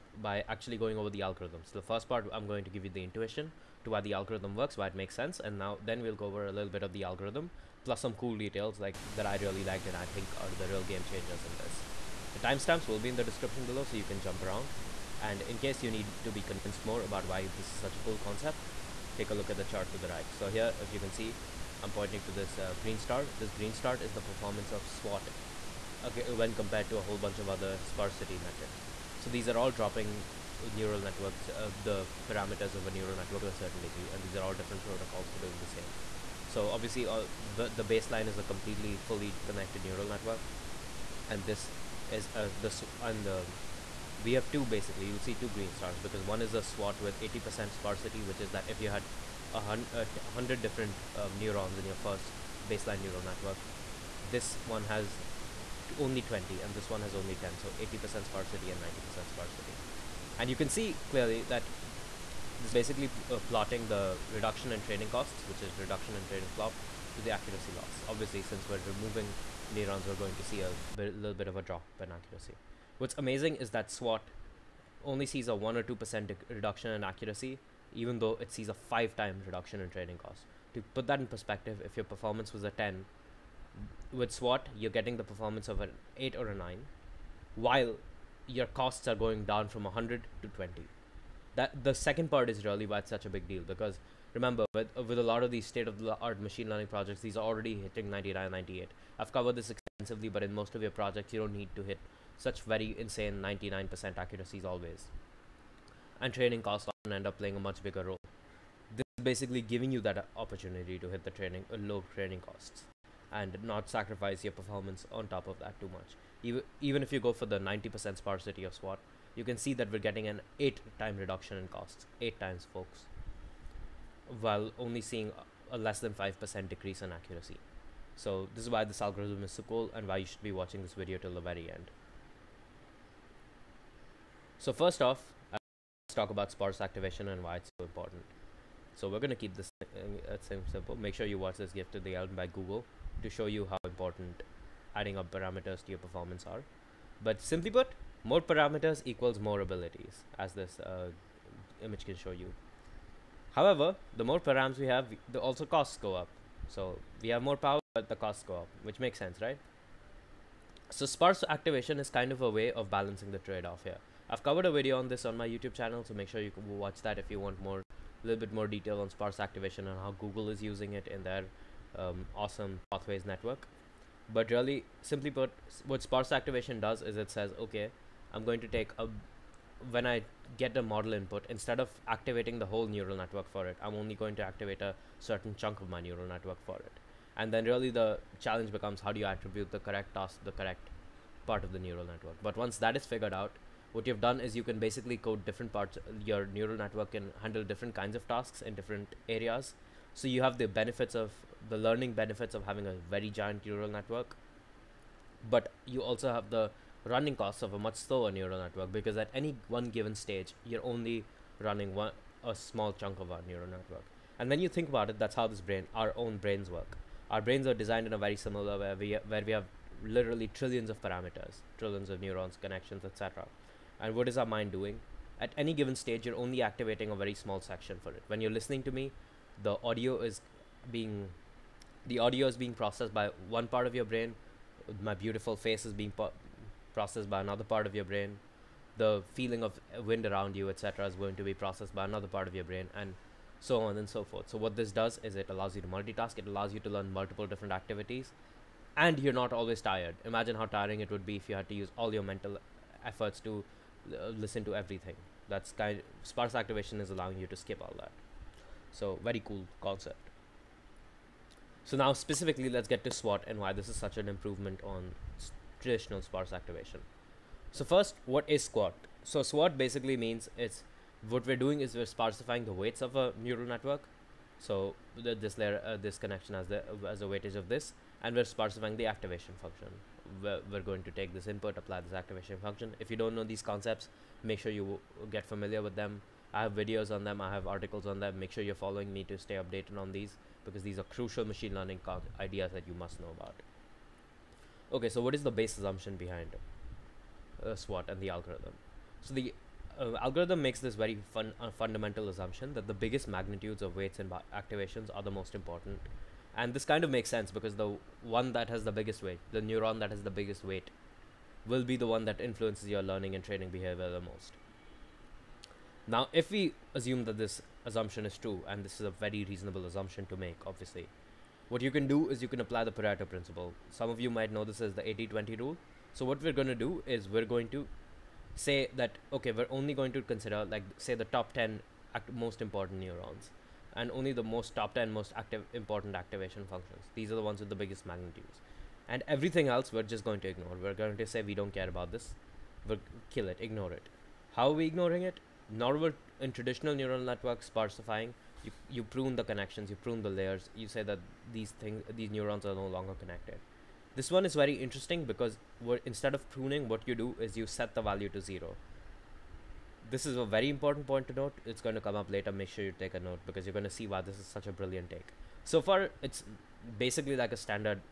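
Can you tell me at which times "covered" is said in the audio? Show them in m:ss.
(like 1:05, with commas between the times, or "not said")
1:39, 2:44.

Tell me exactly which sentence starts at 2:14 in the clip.
So first off, let's talk about sparse activation and why it's so important.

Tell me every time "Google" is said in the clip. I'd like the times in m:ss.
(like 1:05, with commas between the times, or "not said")
2:22, 2:50.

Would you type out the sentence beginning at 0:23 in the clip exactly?
This green star is the performance of SWAT okay, when compared to a whole bunch of other sparsity metrics.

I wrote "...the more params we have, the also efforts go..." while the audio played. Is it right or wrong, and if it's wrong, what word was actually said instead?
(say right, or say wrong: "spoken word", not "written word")
wrong: "costs", not "efforts".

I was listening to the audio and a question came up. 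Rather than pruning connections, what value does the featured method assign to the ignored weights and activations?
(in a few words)
0.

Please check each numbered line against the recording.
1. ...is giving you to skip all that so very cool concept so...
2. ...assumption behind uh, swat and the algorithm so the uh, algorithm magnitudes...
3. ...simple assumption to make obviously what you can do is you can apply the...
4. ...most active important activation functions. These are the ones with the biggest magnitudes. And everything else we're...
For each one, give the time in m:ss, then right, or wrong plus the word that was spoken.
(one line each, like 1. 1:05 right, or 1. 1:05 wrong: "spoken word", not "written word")
1. 4:16 wrong: "allowing", not "giving"
2. 4:55 wrong: "makes", not "magnitudes"
3. 5:19 wrong: "reasonable", not "simple"
4. 5:35 right.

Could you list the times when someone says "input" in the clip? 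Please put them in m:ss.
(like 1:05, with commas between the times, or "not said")
3:01, 4:41.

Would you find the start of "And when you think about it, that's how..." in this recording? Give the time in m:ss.
3:34.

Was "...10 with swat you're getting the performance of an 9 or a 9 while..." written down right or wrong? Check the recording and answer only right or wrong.
wrong.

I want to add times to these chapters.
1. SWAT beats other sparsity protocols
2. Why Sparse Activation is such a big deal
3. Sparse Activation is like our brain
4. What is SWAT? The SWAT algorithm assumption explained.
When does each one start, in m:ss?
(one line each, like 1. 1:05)
1. 0:17
2. 2:14
3. 3:32
4. 4:22.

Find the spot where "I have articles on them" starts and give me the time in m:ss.
4:47.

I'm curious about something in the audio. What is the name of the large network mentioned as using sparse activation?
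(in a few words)
Pathways.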